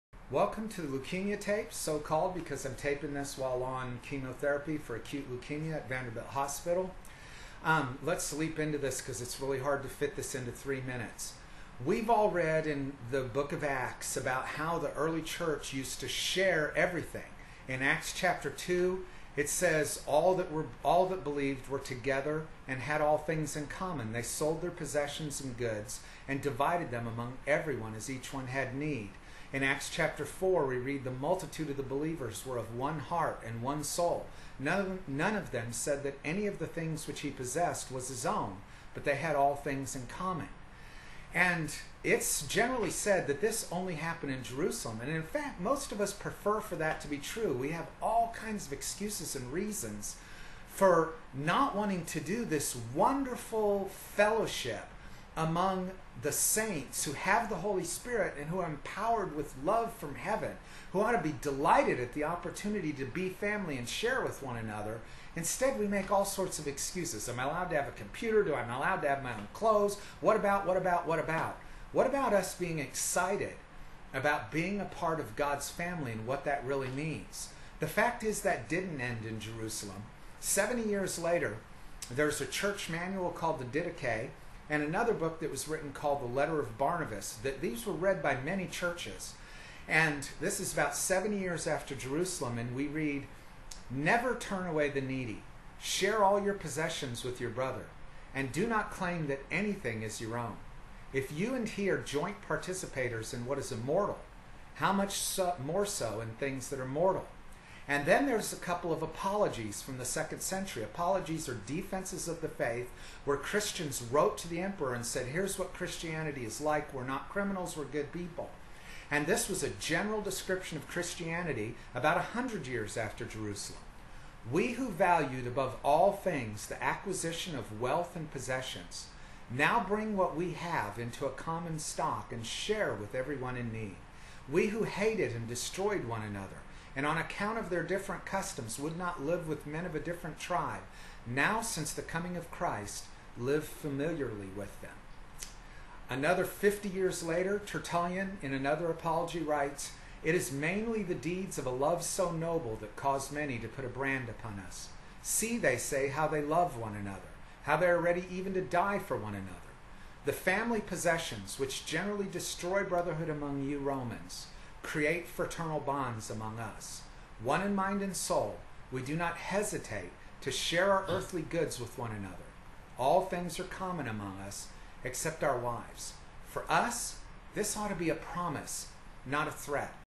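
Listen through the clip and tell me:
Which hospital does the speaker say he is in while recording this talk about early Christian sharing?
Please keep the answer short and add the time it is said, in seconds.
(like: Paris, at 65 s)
Vanderbilt Hospital, at 5 s.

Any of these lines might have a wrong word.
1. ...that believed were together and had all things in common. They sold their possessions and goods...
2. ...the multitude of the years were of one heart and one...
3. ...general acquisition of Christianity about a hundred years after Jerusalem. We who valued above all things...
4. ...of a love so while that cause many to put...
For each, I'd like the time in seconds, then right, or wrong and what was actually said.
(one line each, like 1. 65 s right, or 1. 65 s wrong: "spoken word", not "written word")
1. 21 s right
2. 31 s wrong: "believers", not "years"
3. 119 s wrong: "description", not "acquisition"
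4. 151 s wrong: "noble", not "while".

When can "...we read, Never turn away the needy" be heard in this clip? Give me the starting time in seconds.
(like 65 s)
92 s.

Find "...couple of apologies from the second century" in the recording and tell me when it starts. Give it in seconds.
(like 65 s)
108 s.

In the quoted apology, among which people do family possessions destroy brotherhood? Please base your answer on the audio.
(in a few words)
Romans.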